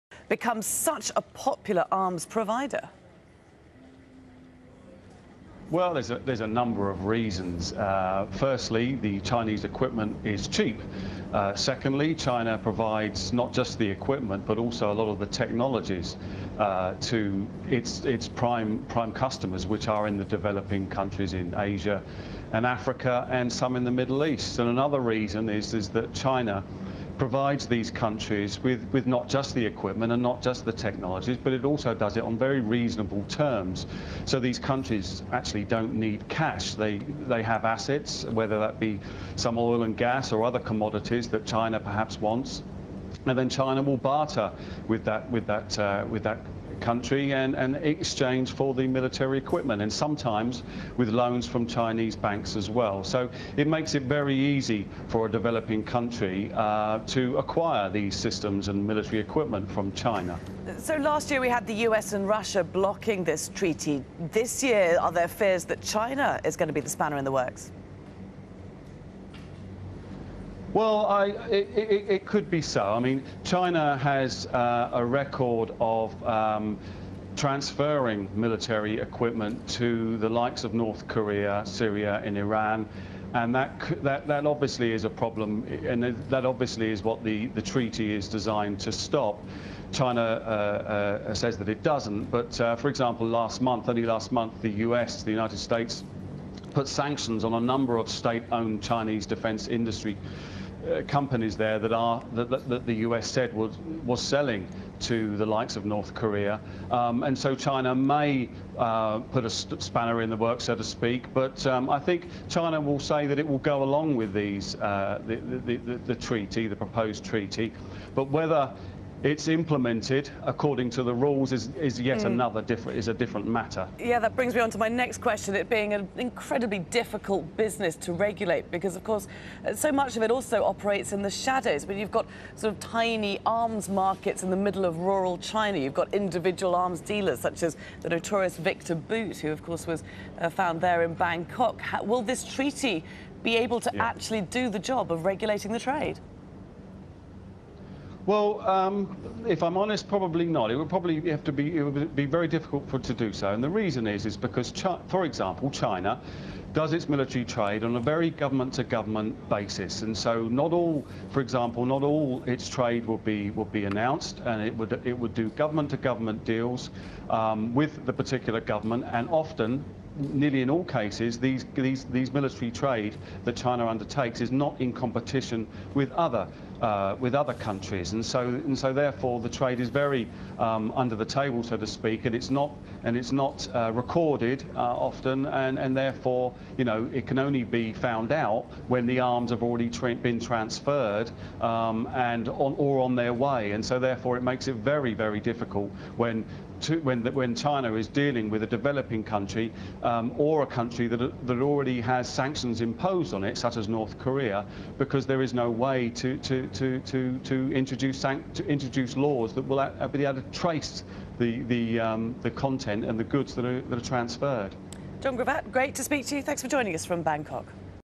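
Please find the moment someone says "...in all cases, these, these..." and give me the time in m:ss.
2:50.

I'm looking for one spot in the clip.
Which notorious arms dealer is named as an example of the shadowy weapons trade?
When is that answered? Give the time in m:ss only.
2:18.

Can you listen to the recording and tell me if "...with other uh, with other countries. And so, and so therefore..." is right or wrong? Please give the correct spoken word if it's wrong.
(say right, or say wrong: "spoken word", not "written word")
right.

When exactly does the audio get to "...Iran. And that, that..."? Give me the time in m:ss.
1:22.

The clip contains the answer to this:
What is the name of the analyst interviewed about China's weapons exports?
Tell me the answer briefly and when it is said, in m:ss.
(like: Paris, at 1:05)
Jon Grevatt, at 3:35.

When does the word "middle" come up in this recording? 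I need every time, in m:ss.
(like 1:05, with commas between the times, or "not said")
0:23, 2:14.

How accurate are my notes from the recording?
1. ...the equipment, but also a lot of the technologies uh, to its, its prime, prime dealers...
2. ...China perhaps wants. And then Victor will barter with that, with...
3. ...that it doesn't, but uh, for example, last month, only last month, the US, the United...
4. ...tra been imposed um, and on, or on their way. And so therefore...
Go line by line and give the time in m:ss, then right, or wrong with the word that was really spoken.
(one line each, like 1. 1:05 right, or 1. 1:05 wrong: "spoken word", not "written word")
1. 0:13 wrong: "customers", not "dealers"
2. 0:41 wrong: "China", not "Victor"
3. 1:31 right
4. 3:09 wrong: "transferred", not "imposed".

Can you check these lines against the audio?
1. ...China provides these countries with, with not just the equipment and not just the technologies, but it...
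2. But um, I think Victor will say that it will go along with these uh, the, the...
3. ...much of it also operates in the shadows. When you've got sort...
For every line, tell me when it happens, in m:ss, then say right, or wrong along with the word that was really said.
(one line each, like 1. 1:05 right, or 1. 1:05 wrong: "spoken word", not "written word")
1. 0:26 right
2. 1:51 wrong: "China", not "Victor"
3. 2:09 right.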